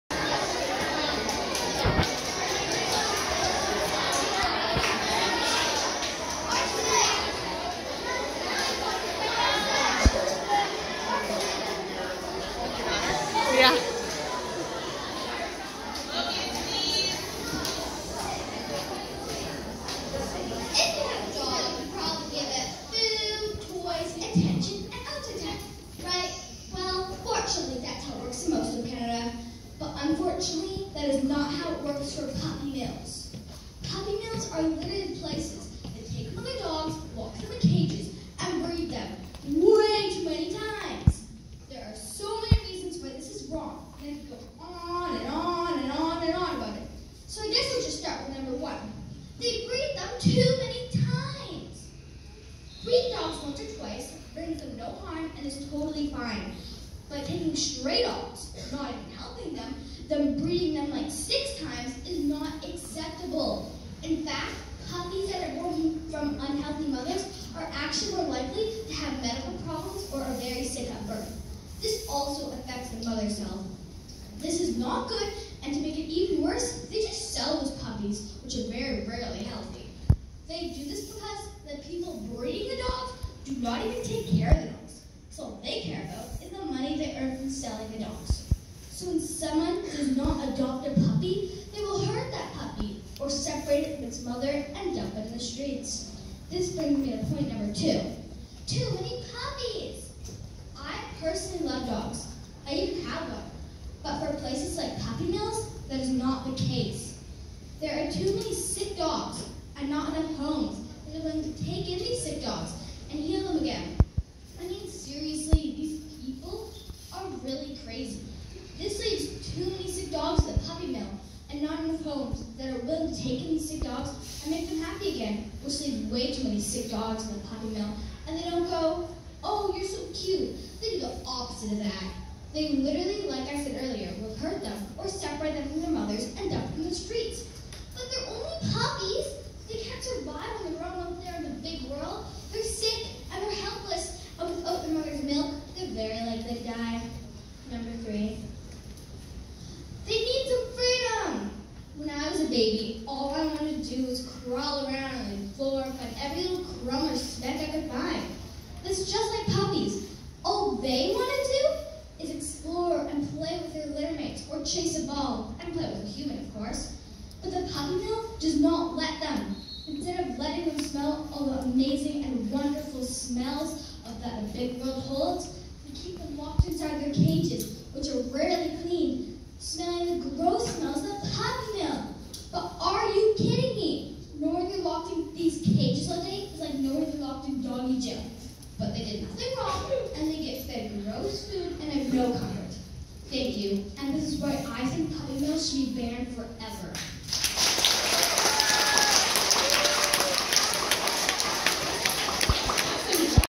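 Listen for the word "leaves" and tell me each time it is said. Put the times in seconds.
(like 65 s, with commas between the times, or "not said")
118 s, 125 s.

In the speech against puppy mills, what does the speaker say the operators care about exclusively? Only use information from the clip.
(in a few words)
the money.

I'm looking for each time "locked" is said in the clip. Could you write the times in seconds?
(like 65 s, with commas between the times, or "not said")
176 s, 187 s.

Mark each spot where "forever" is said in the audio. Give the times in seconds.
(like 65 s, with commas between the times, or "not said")
196 s.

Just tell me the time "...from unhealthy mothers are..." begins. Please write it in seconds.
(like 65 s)
66 s.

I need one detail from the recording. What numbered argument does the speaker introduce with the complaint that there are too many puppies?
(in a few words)
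point number 2.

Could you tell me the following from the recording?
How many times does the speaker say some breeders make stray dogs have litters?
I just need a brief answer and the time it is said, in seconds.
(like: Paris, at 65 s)
6 times, at 61 s.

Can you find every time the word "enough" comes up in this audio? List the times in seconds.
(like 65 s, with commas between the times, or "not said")
110 s, 121 s.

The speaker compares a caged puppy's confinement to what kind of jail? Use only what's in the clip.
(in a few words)
doggy jail.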